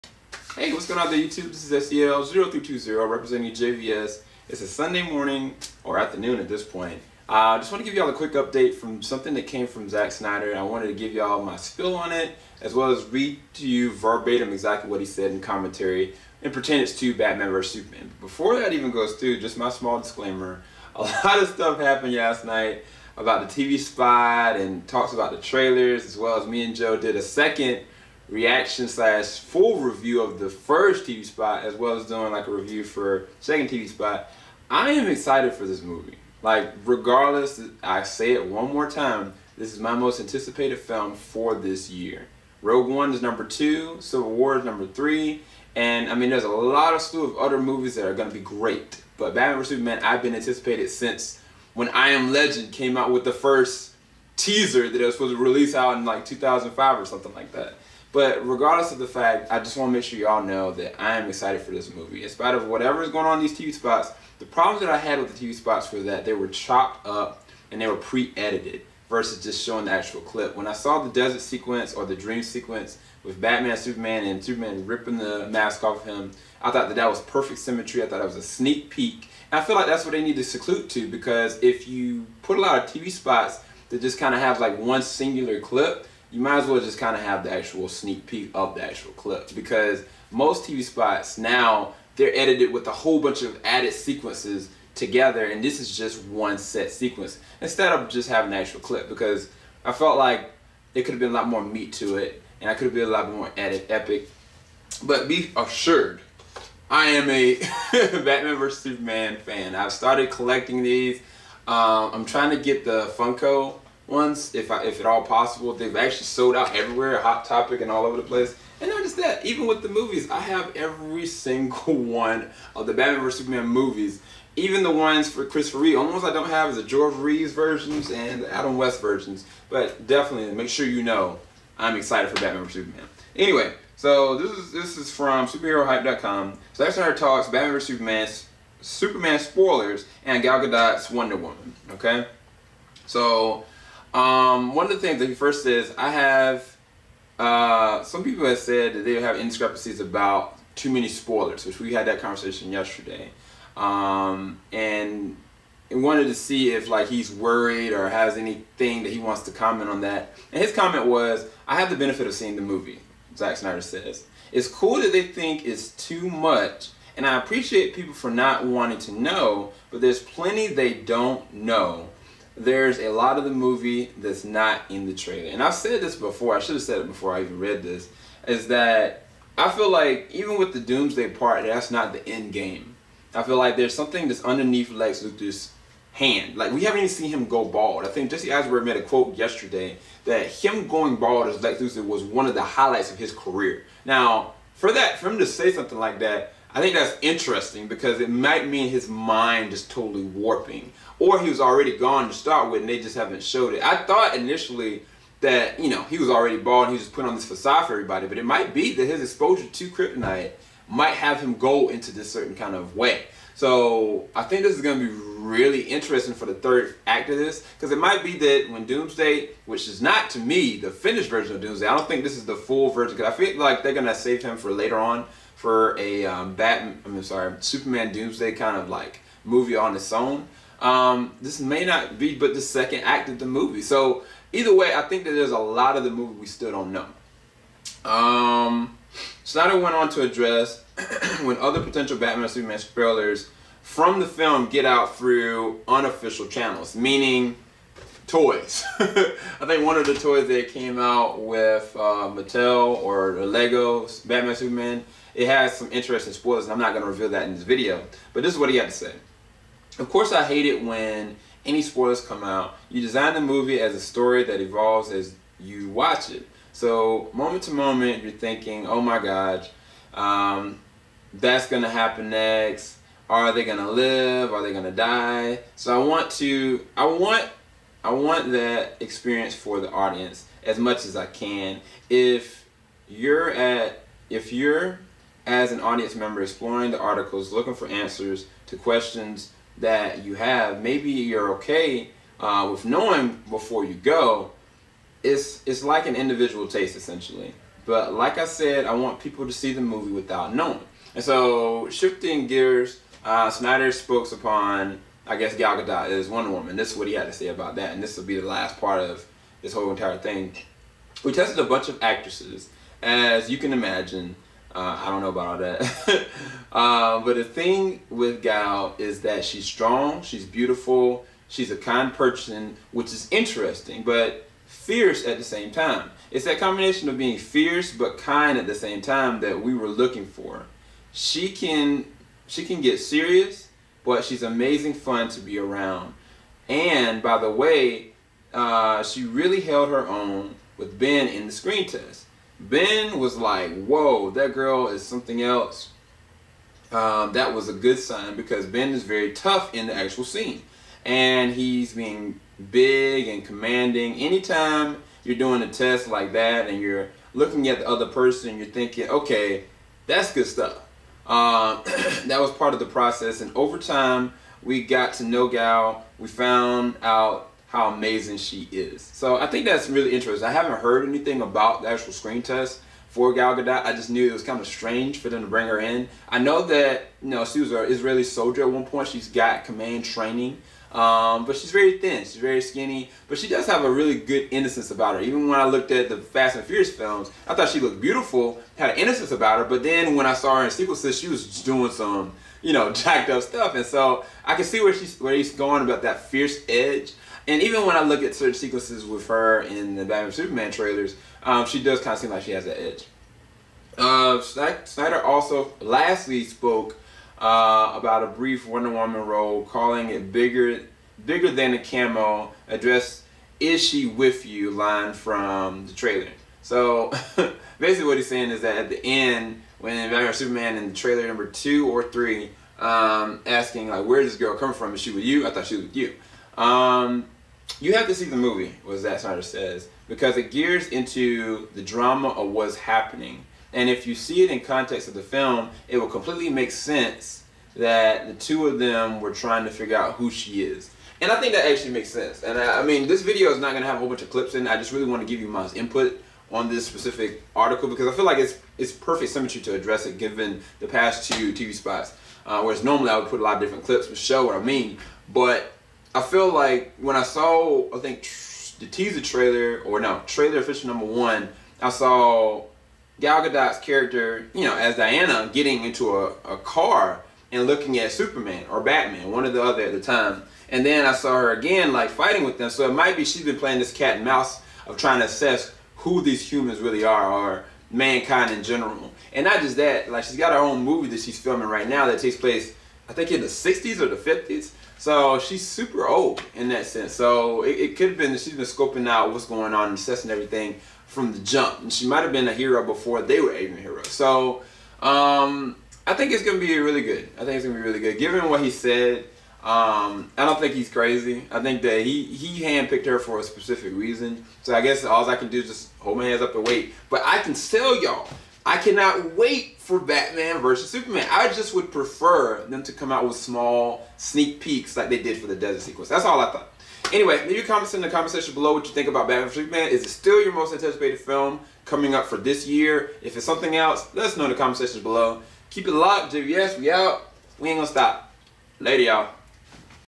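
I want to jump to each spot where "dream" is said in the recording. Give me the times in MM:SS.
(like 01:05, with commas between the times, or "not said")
01:12.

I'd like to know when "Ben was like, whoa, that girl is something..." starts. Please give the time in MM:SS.
05:42.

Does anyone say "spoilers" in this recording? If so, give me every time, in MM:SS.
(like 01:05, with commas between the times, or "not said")
02:19, 02:31, 04:02, 04:16, 04:21.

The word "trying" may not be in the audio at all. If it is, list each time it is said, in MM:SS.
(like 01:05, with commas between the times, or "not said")
01:52, 07:19, 07:54.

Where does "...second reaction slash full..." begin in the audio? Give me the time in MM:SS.
00:27.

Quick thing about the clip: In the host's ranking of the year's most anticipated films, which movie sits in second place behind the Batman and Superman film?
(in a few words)
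Rogue One.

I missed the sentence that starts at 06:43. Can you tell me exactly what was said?
Uh, Snyder also lastly spoke uh, about a brief Wonder Woman role, calling it bigger, bigger than a cameo.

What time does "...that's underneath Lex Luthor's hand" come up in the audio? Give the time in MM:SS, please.
03:04.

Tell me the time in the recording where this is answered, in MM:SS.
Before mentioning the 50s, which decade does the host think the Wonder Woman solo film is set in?
08:03.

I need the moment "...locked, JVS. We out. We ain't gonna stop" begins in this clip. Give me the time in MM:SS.
08:45.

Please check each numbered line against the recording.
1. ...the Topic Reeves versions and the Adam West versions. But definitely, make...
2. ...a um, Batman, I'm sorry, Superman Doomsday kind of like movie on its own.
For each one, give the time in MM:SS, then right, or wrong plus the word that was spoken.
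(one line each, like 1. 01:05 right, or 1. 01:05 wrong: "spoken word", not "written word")
1. 02:06 wrong: "George", not "Topic"
2. 03:45 right.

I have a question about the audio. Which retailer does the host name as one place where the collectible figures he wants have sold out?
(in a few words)
Hot Topic.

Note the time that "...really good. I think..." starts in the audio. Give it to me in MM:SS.
08:16.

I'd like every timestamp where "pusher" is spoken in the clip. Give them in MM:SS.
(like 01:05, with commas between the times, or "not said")
not said.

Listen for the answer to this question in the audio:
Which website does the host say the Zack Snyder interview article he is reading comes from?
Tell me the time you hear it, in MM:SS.
02:15.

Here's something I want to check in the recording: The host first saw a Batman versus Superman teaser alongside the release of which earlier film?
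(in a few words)
I Am Legend.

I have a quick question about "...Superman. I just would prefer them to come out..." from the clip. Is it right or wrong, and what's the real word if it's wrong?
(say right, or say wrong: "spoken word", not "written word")
right.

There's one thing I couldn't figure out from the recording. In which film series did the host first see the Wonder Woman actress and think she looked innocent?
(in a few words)
Fast and Furious.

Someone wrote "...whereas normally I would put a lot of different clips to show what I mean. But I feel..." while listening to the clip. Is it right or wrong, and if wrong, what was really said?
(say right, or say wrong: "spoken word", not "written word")
right.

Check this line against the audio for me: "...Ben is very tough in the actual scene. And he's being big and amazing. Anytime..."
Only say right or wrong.
wrong.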